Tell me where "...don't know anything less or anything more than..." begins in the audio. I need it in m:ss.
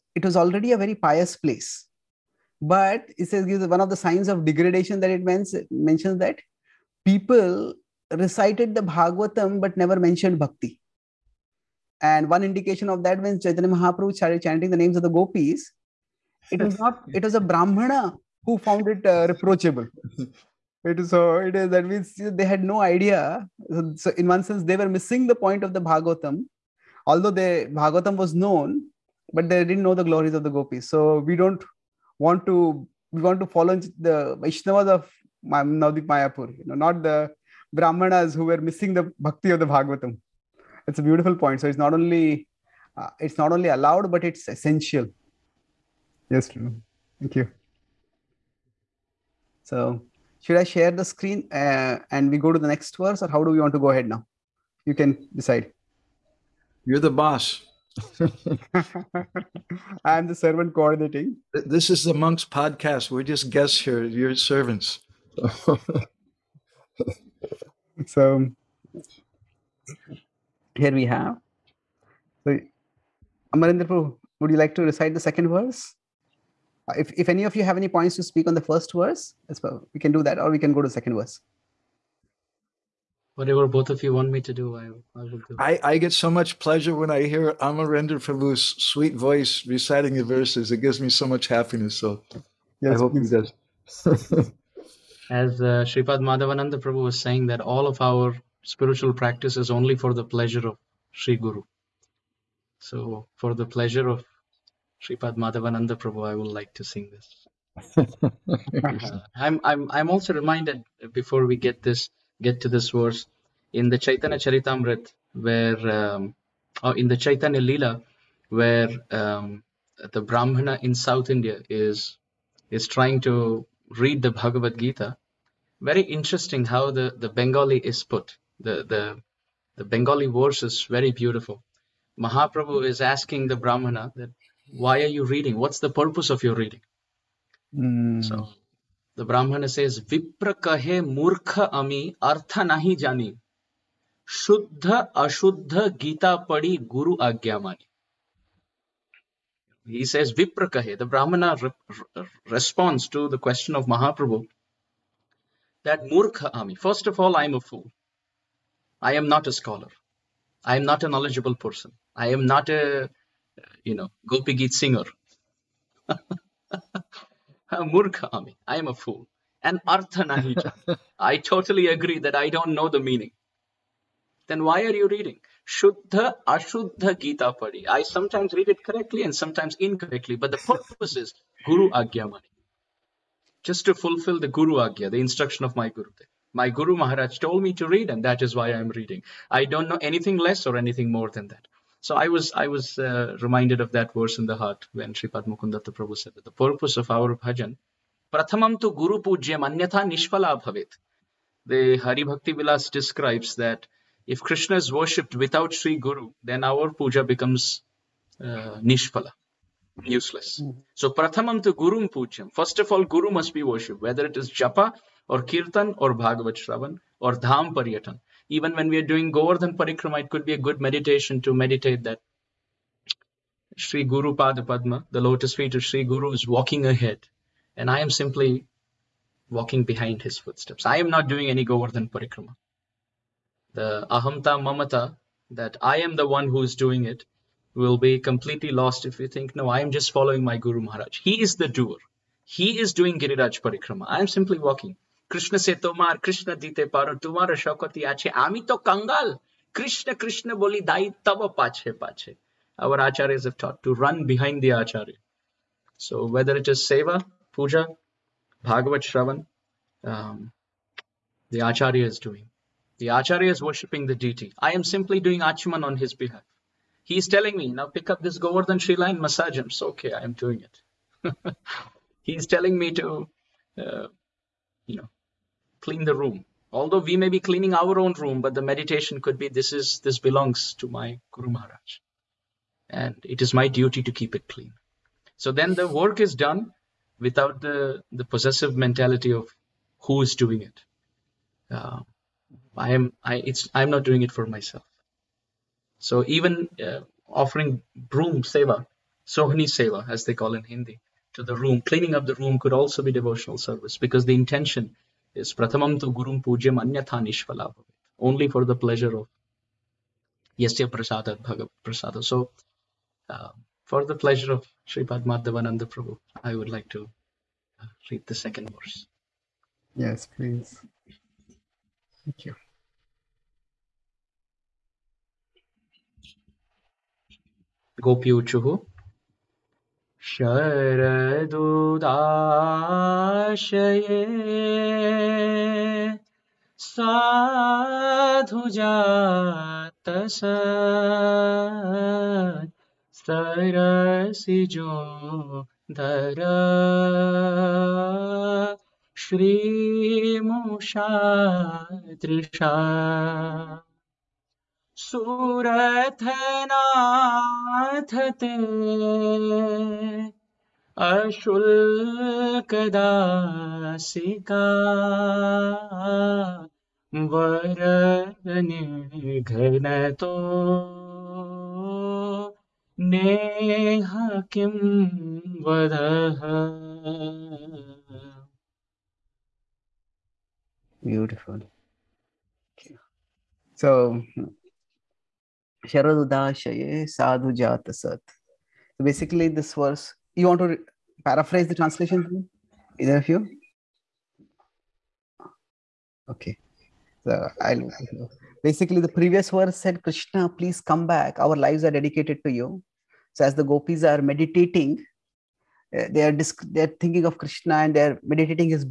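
3:09.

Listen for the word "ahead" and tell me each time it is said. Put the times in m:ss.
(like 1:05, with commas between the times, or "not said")
0:53, 3:46.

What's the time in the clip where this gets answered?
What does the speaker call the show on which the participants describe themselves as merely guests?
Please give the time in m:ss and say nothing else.
1:02.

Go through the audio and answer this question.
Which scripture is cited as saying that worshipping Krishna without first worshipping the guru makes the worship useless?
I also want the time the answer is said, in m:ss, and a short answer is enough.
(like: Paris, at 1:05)
Hari Bhakti Vilas, at 3:22.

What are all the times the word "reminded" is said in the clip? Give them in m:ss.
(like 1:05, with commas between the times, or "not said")
1:50, 3:13.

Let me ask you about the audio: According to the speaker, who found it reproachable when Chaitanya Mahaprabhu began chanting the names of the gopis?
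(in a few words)
A Brahmana.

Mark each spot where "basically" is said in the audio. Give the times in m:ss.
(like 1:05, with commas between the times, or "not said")
6:29, 6:38.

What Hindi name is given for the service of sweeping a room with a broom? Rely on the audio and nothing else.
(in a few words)
Sohni seva.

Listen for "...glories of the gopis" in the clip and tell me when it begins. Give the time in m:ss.
0:30.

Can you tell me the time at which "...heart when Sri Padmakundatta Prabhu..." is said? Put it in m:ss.
3:14.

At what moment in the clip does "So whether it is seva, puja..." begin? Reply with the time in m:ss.
4:16.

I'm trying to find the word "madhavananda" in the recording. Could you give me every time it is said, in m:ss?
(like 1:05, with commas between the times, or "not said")
1:36, 1:45, 5:15.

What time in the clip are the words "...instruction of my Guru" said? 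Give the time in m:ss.
3:05.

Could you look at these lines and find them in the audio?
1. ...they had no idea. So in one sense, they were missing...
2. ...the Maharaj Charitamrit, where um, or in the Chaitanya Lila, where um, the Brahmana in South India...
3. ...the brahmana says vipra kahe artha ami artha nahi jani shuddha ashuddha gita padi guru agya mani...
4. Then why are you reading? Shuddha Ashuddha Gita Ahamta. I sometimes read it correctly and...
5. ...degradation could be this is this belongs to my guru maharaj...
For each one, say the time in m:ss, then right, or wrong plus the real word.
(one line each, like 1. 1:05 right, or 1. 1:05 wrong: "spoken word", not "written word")
1. 0:22 right
2. 1:53 wrong: "Chaitanya", not "Maharaj"
3. 2:19 wrong: "murkha", not "artha"
4. 2:54 wrong: "Padi", not "Ahamta"
5. 4:38 wrong: "meditation", not "degradation".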